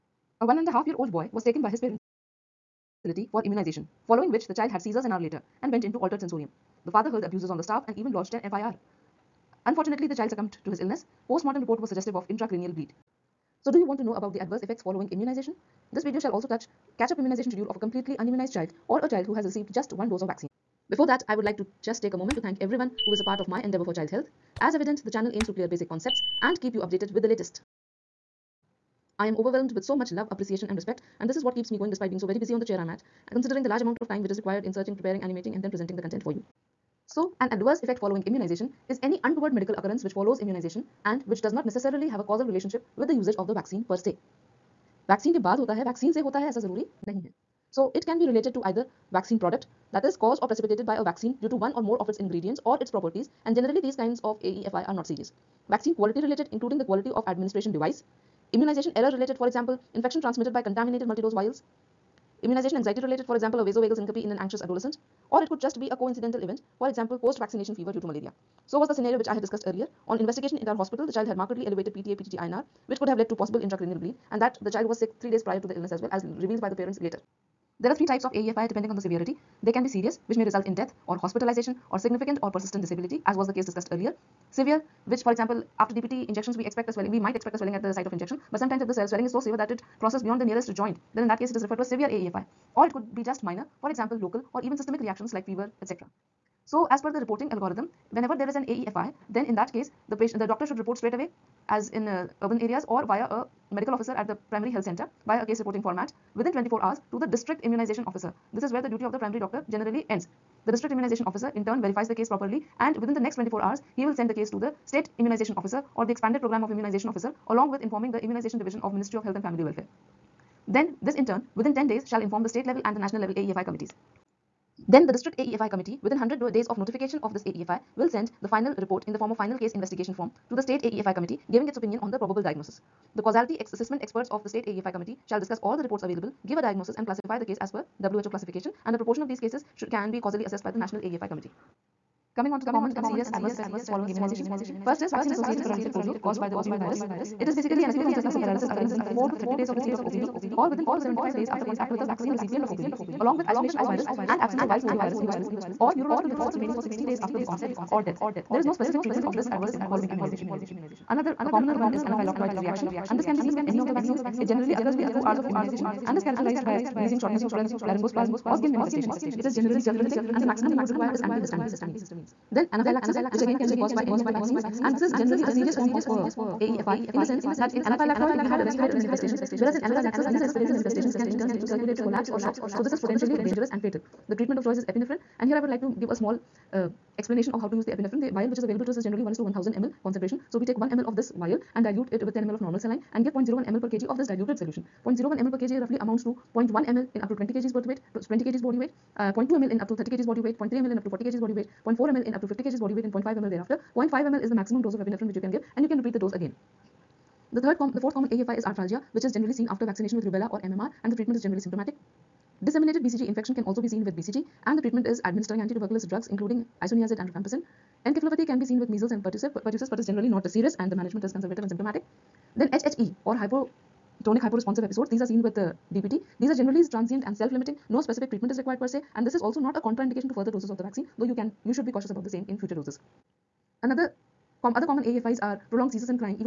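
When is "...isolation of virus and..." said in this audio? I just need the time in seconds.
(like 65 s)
153 s.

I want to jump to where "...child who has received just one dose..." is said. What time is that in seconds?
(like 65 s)
19 s.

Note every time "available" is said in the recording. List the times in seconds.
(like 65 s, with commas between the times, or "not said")
136 s, 188 s.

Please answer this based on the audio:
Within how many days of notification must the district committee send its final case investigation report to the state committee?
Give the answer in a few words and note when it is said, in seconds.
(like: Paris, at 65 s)
100 days, at 126 s.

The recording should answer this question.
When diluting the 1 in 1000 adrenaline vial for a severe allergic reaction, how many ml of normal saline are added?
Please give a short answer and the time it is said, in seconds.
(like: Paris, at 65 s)
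10 ml, at 192 s.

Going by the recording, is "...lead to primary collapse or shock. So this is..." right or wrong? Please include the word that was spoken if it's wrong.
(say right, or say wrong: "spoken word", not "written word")
wrong: "circulatory", not "primary".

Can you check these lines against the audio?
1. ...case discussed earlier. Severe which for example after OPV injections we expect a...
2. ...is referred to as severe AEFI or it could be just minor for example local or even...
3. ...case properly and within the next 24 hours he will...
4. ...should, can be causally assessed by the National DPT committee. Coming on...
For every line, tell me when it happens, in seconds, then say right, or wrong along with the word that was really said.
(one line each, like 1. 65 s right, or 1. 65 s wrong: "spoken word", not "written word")
1. 83 s wrong: "DPT", not "OPV"
2. 91 s right
3. 112 s right
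4. 139 s wrong: "AEFI", not "DPT".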